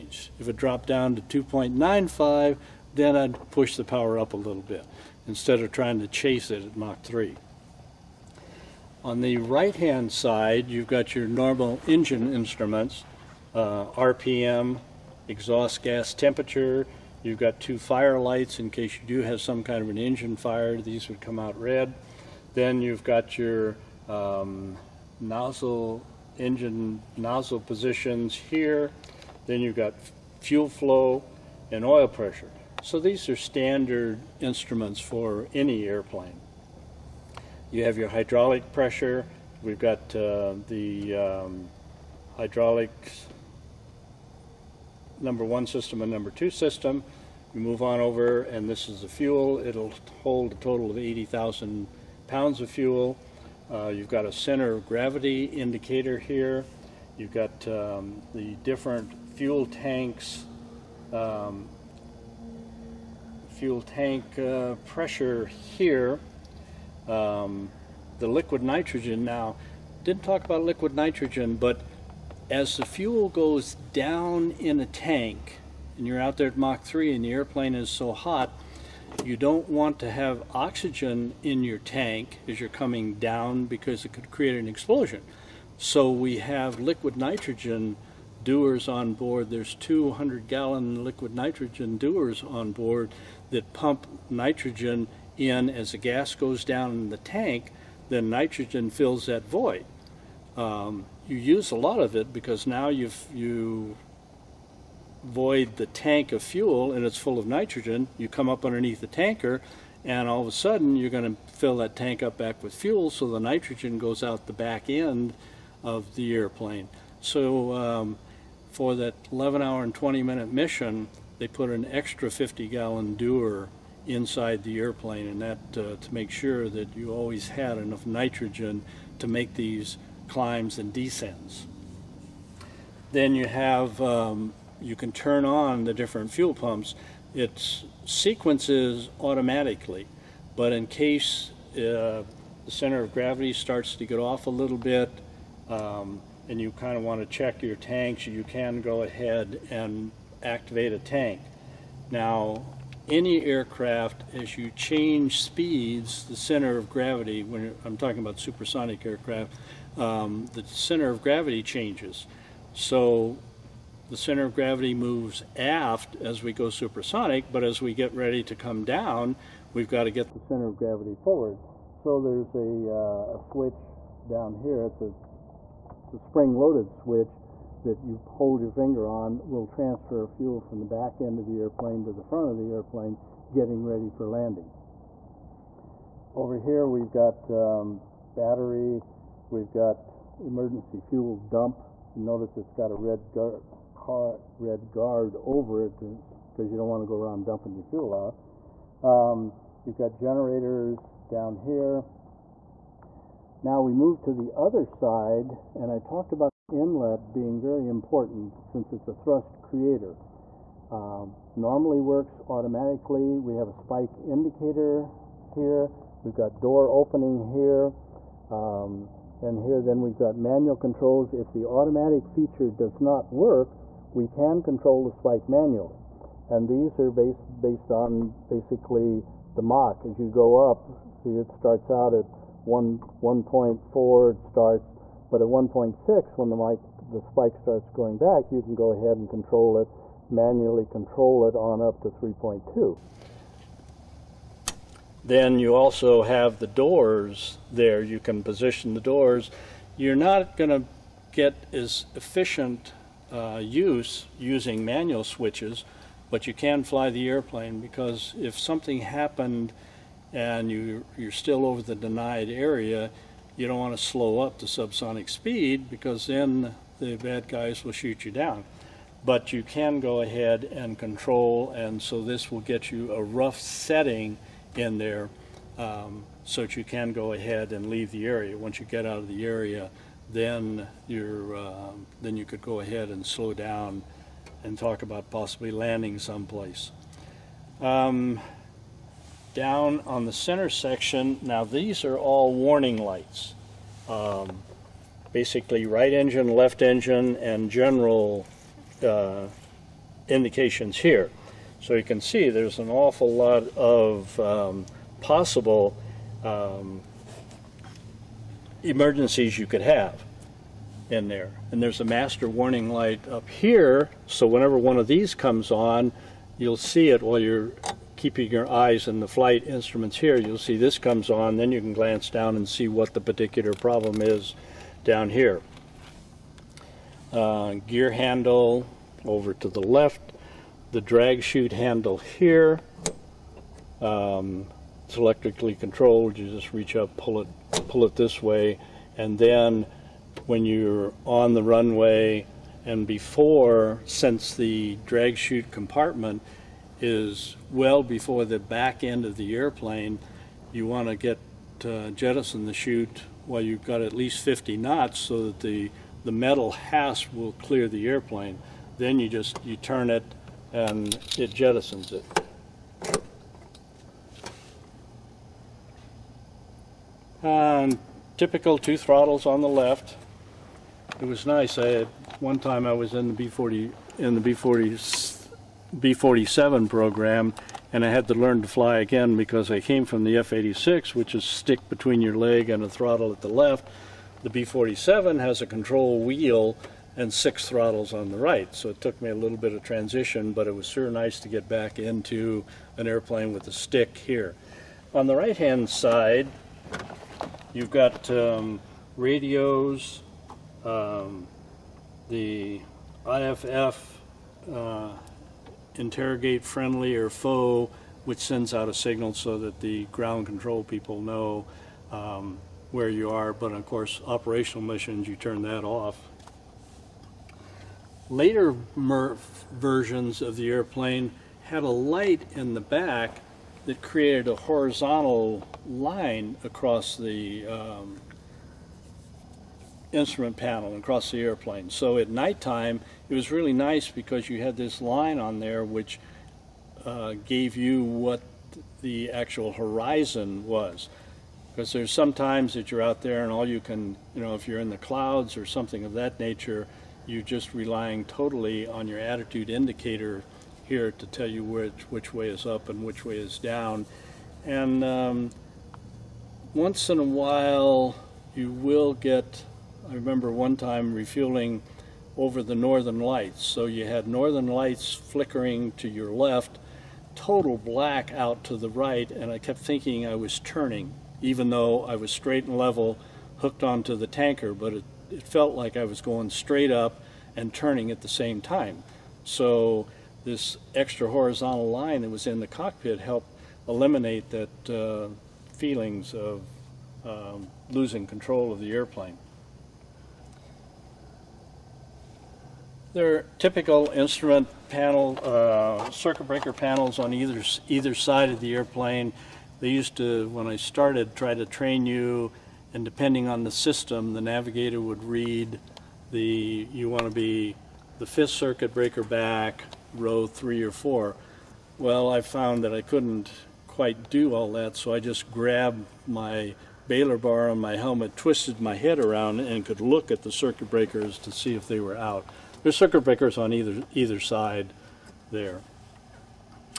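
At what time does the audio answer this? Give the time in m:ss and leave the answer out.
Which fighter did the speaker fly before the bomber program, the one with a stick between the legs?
6:20.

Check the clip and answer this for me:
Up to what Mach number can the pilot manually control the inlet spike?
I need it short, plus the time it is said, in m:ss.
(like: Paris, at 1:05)
3.2, at 4:02.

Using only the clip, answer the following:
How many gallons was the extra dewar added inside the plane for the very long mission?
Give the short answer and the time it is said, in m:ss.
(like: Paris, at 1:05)
50 gallons, at 2:02.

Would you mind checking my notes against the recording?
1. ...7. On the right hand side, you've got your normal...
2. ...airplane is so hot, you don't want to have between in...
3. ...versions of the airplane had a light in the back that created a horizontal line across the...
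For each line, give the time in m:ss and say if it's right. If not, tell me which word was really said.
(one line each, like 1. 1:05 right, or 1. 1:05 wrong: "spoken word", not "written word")
1. 0:07 wrong: "3", not "7"
2. 1:17 wrong: "oxygen", not "between"
3. 6:59 right.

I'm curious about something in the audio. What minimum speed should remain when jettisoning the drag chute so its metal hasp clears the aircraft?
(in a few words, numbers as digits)
50 knots.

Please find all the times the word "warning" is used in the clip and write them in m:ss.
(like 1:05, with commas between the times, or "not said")
4:52, 5:12.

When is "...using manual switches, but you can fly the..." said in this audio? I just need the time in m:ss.
4:14.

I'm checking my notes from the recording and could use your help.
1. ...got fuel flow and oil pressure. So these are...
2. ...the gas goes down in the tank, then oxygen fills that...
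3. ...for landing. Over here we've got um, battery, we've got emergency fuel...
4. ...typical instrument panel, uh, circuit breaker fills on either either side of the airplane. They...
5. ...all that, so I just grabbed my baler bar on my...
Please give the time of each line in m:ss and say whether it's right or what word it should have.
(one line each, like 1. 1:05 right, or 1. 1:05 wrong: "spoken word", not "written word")
1. 0:29 right
2. 1:35 wrong: "nitrogen", not "oxygen"
3. 3:04 right
4. 8:13 wrong: "panels", not "fills"
5. 8:34 right.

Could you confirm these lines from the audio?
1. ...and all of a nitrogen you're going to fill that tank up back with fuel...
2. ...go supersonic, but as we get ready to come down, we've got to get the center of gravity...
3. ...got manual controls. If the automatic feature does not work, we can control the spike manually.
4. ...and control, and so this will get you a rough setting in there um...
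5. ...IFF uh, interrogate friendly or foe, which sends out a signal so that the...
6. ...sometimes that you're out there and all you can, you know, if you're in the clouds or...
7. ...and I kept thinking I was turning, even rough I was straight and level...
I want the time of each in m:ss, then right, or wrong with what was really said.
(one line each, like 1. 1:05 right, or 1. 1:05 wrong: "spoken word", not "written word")
1. 1:50 wrong: "sudden", not "nitrogen"
2. 2:46 right
3. 3:40 right
4. 4:30 right
5. 6:43 right
6. 7:22 right
7. 7:49 wrong: "though", not "rough".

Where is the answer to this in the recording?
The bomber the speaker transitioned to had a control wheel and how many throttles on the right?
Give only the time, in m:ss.
6:27.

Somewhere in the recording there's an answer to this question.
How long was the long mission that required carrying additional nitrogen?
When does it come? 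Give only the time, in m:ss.
1:59.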